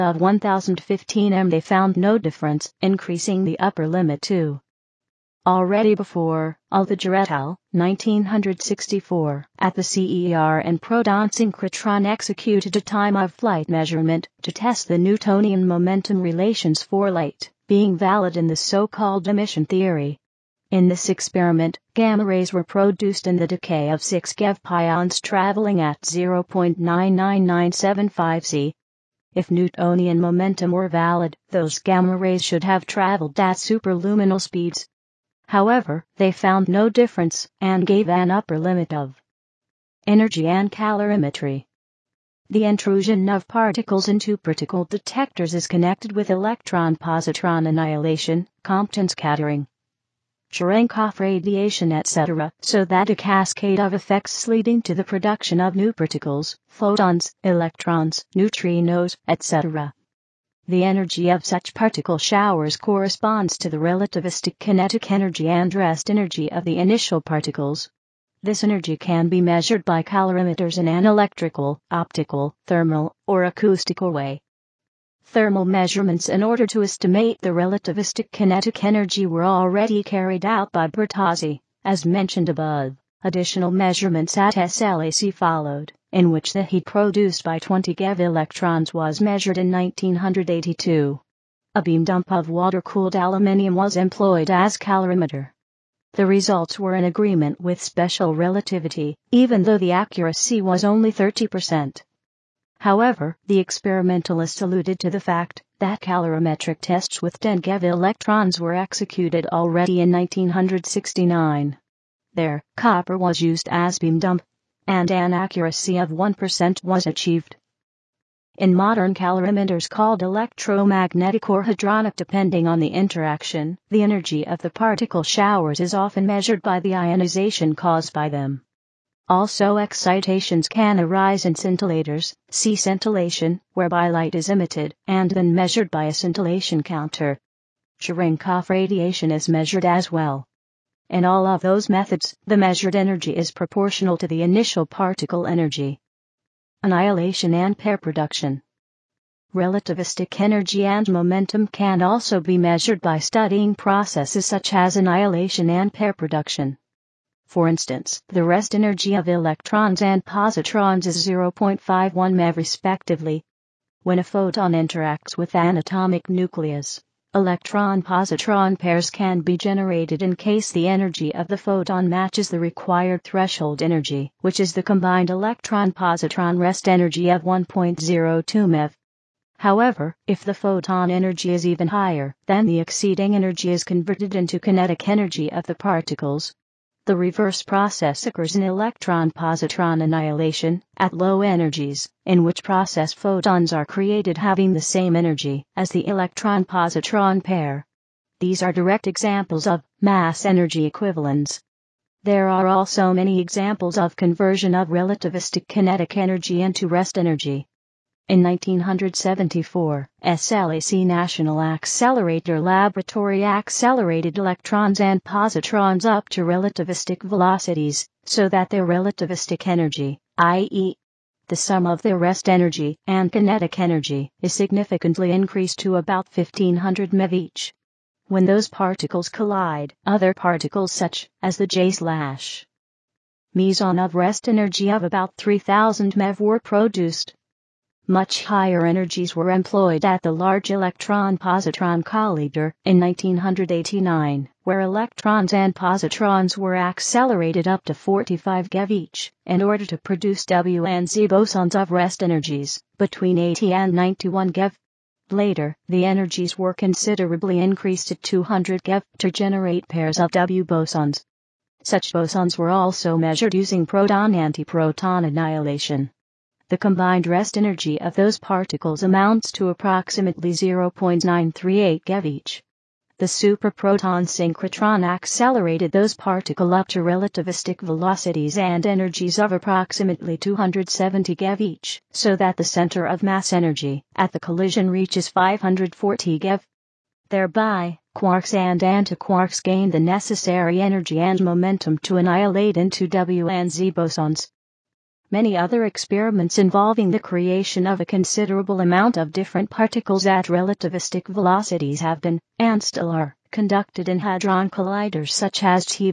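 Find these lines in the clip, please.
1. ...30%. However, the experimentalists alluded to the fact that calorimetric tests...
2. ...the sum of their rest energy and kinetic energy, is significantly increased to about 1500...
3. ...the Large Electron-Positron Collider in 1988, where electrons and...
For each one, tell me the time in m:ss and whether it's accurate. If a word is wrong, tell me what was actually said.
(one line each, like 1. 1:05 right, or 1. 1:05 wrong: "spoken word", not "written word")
1. 1:41 right
2. 3:41 right
3. 4:00 wrong: "1989", not "1988".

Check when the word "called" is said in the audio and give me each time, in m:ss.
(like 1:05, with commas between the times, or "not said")
0:18, 1:59.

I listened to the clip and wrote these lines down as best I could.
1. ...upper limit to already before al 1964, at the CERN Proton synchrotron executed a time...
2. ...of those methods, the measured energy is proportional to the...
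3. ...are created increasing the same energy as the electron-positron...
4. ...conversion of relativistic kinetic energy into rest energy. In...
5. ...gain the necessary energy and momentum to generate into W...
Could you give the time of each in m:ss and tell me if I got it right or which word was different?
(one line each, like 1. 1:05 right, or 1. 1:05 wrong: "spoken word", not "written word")
1. 0:03 right
2. 2:21 right
3. 3:13 wrong: "having", not "increasing"
4. 3:24 right
5. 4:49 wrong: "annihilate", not "generate".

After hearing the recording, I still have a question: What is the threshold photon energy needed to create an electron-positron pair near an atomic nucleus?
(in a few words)
1.02 MeV.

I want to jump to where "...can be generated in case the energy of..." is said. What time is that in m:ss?
2:49.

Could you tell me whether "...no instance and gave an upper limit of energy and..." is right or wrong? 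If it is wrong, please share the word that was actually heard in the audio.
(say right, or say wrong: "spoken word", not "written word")
wrong: "difference", not "instance".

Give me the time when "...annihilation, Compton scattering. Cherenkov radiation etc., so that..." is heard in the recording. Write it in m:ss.
0:47.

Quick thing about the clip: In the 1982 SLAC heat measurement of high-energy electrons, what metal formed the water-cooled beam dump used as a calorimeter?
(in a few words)
Aluminium.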